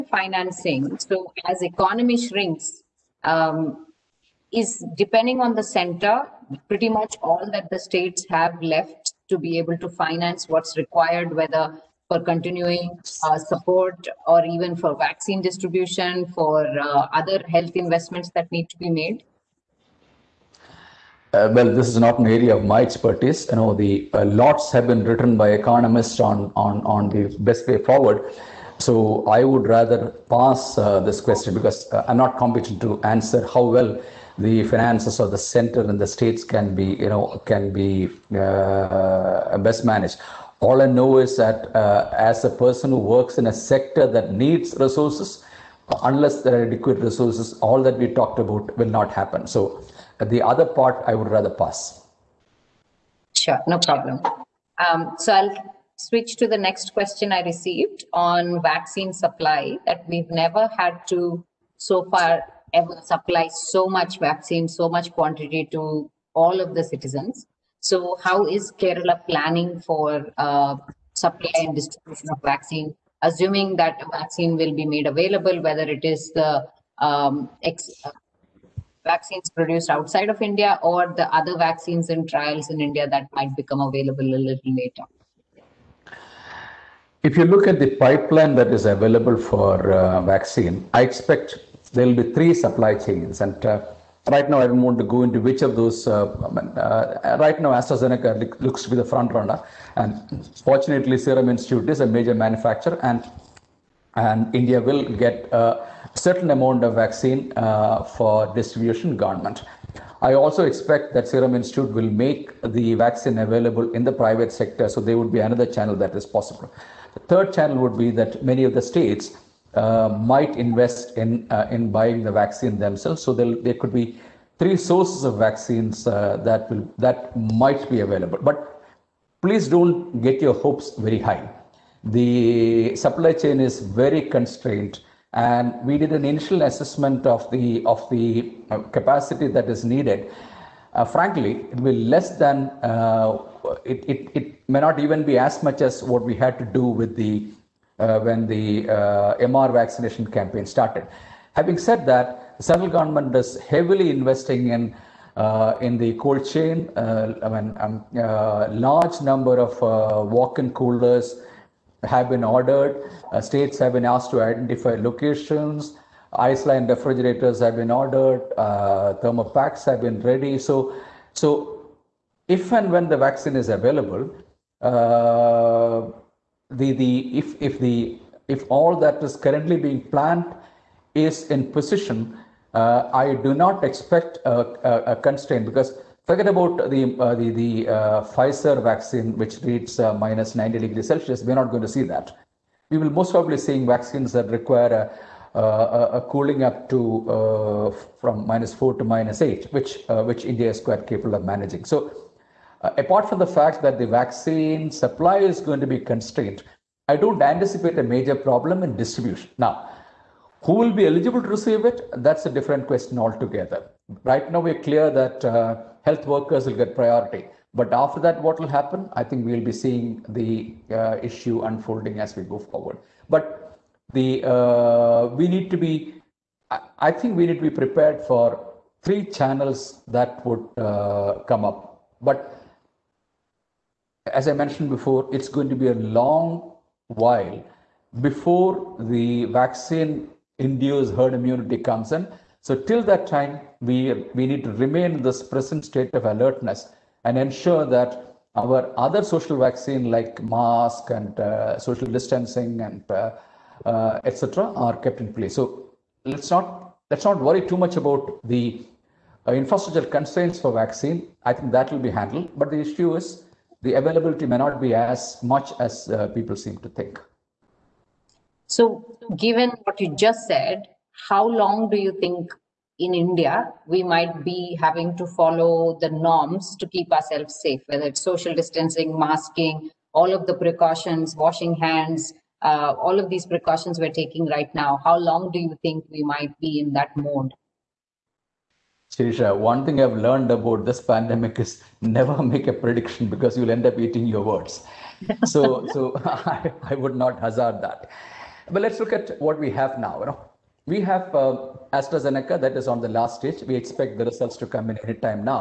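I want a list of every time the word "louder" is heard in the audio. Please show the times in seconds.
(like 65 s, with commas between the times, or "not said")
not said.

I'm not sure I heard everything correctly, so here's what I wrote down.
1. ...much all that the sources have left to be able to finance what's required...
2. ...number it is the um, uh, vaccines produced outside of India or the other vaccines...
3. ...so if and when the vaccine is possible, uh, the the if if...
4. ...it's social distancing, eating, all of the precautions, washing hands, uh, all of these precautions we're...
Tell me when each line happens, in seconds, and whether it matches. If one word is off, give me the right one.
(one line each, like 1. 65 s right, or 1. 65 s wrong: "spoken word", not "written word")
1. 6 s wrong: "states", not "sources"
2. 75 s wrong: "whether", not "number"
3. 171 s wrong: "available", not "possible"
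4. 278 s wrong: "masking", not "eating".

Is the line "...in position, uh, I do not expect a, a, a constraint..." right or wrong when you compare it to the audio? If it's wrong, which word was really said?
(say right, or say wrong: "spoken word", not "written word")
right.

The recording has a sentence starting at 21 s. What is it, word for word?
Uh, well, this is not an area of my expertise.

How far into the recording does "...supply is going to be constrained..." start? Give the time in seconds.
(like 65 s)
204 s.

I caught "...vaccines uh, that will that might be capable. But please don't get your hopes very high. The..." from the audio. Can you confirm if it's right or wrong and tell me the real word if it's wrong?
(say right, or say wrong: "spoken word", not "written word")
wrong: "available", not "capable".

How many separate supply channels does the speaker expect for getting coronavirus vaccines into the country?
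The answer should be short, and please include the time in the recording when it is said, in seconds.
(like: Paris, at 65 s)
3, at 92 s.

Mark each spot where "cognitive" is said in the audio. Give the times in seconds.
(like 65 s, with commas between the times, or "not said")
not said.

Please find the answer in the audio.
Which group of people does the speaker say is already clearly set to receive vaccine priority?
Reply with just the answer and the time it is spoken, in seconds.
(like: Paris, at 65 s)
Health workers, at 216 s.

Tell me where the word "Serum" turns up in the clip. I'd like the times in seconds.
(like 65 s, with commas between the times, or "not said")
101 s, 111 s.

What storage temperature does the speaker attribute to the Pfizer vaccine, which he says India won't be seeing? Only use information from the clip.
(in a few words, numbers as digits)
-90 degrees Celsius.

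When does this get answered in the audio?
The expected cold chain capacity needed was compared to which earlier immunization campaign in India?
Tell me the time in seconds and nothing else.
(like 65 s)
149 s.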